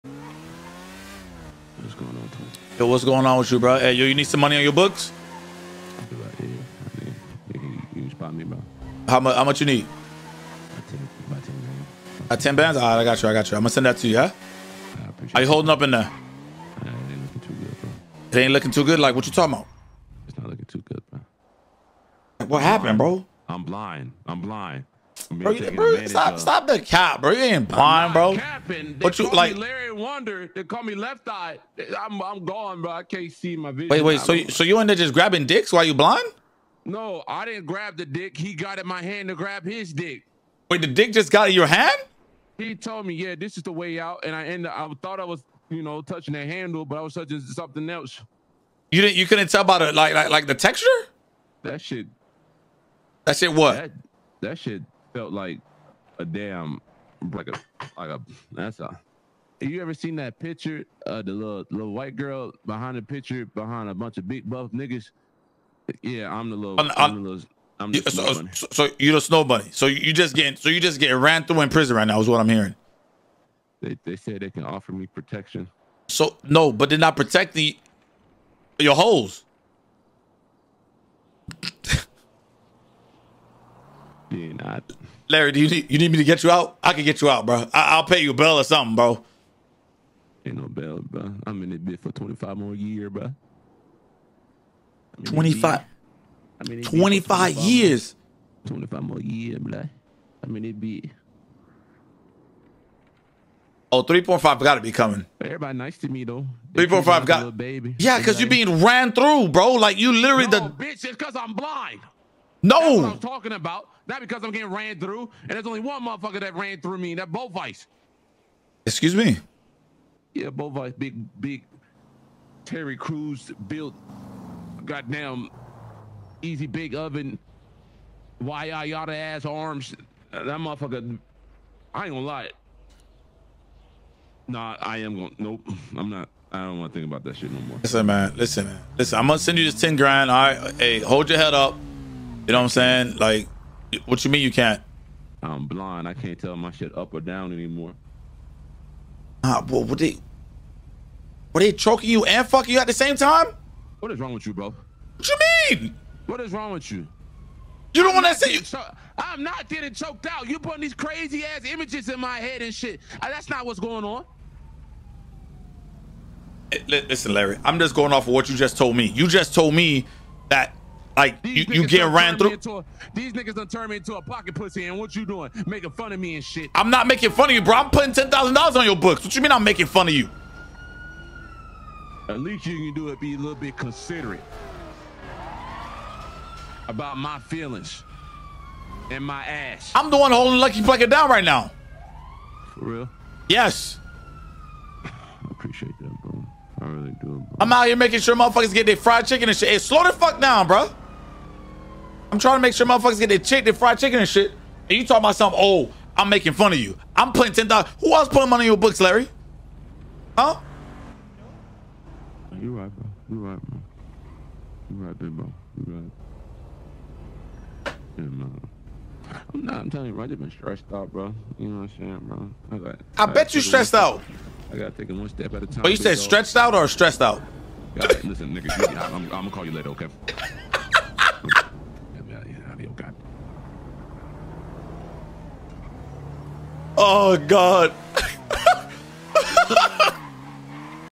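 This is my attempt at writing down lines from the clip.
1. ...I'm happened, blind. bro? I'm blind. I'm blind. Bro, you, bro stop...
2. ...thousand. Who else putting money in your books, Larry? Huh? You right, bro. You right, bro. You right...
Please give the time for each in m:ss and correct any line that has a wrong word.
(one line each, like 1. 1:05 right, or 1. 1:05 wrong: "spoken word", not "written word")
1. 0:22 right
2. 3:27 right.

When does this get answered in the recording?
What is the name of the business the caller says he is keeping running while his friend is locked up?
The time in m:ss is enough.
3:10.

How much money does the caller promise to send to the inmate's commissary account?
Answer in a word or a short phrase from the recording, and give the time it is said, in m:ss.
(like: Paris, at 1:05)
10 grand, at 2:19.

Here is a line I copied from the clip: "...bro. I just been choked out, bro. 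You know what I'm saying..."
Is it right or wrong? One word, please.
wrong.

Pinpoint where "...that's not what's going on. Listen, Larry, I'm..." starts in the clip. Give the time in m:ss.
2:43.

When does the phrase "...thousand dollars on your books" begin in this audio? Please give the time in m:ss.
2:58.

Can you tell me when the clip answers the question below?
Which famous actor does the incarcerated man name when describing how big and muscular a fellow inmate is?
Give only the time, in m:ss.
2:02.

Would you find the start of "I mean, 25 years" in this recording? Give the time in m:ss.
1:36.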